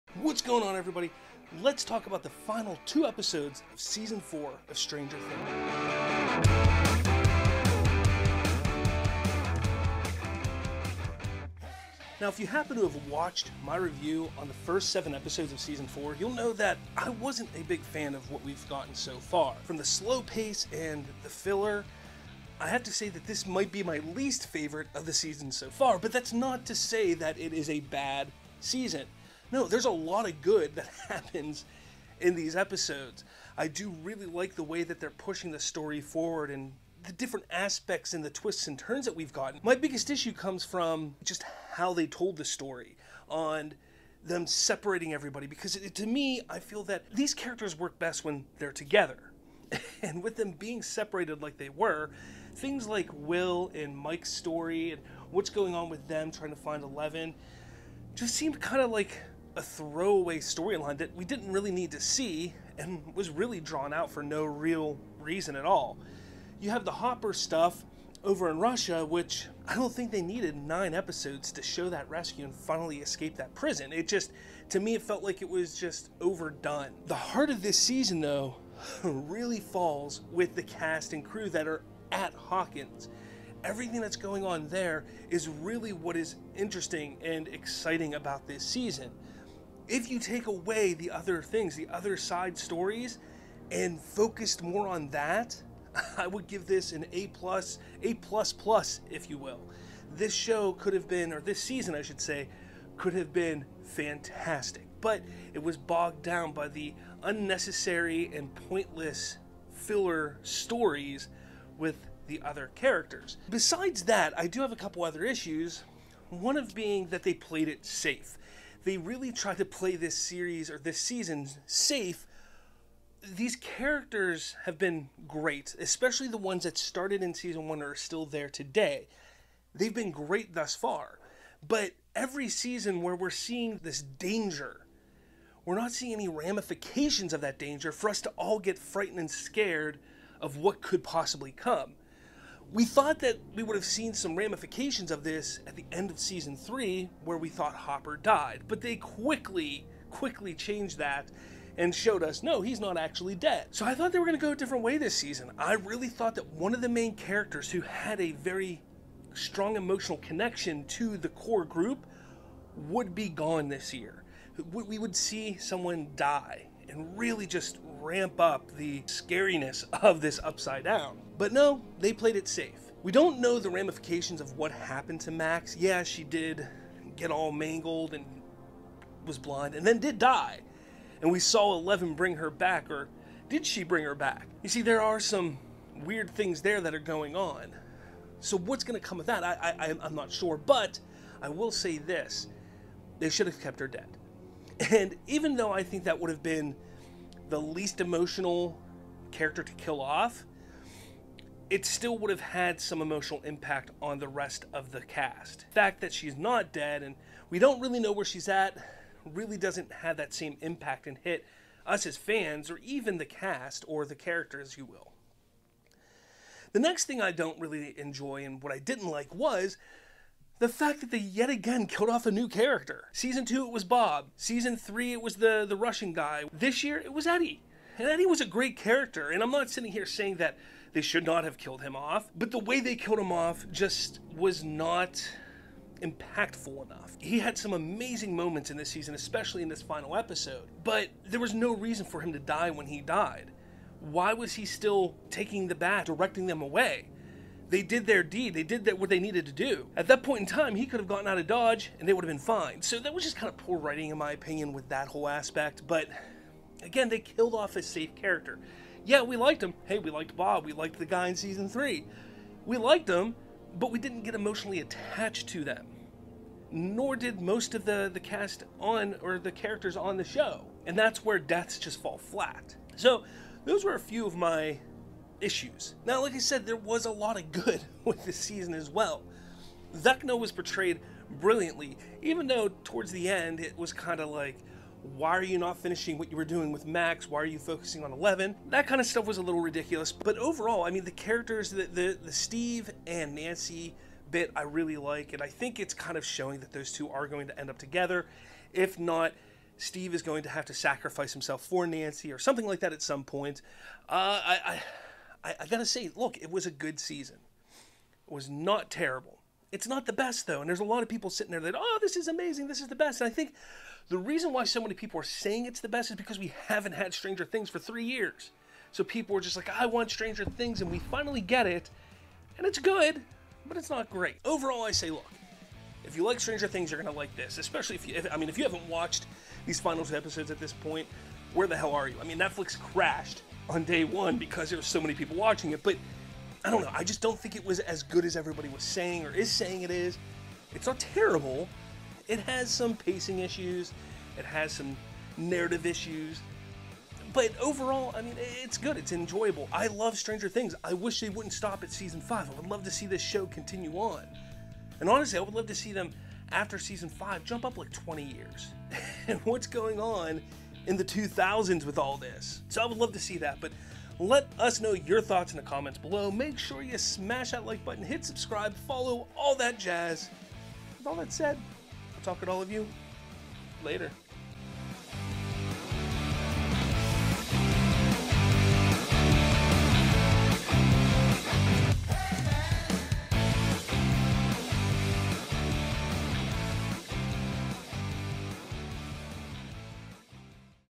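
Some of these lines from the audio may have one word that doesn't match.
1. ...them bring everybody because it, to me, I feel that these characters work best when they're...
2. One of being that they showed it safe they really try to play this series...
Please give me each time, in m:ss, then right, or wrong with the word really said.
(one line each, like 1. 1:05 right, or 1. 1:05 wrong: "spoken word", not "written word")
1. 0:44 wrong: "separating", not "bring"
2. 1:56 wrong: "played", not "showed".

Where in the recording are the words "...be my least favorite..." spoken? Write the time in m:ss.
0:23.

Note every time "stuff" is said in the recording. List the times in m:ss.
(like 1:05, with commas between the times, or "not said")
1:07, 4:49.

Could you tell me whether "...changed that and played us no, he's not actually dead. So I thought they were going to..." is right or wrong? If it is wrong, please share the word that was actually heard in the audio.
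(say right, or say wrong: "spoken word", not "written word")
wrong: "showed", not "played".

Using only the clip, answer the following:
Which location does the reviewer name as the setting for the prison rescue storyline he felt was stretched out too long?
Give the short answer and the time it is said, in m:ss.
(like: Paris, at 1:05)
Russia, at 1:08.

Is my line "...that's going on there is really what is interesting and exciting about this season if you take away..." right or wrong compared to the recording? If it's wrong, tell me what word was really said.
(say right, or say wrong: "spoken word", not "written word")
right.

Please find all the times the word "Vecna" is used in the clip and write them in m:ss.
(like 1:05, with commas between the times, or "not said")
4:39.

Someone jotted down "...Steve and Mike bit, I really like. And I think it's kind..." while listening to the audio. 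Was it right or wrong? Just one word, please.
wrong.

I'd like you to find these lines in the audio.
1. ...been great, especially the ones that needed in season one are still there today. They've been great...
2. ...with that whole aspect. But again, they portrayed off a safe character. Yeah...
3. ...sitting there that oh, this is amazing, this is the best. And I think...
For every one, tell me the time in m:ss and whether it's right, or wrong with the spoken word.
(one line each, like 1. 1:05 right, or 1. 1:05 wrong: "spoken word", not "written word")
1. 2:04 wrong: "started", not "needed"
2. 4:14 wrong: "killed", not "portrayed"
3. 5:11 right.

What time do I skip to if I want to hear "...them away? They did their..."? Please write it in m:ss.
4:06.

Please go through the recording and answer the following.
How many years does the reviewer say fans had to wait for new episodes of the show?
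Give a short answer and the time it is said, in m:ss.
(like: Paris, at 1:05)
3, at 5:17.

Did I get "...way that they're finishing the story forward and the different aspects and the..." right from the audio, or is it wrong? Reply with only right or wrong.
wrong.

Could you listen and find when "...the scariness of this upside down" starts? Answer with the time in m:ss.
2:48.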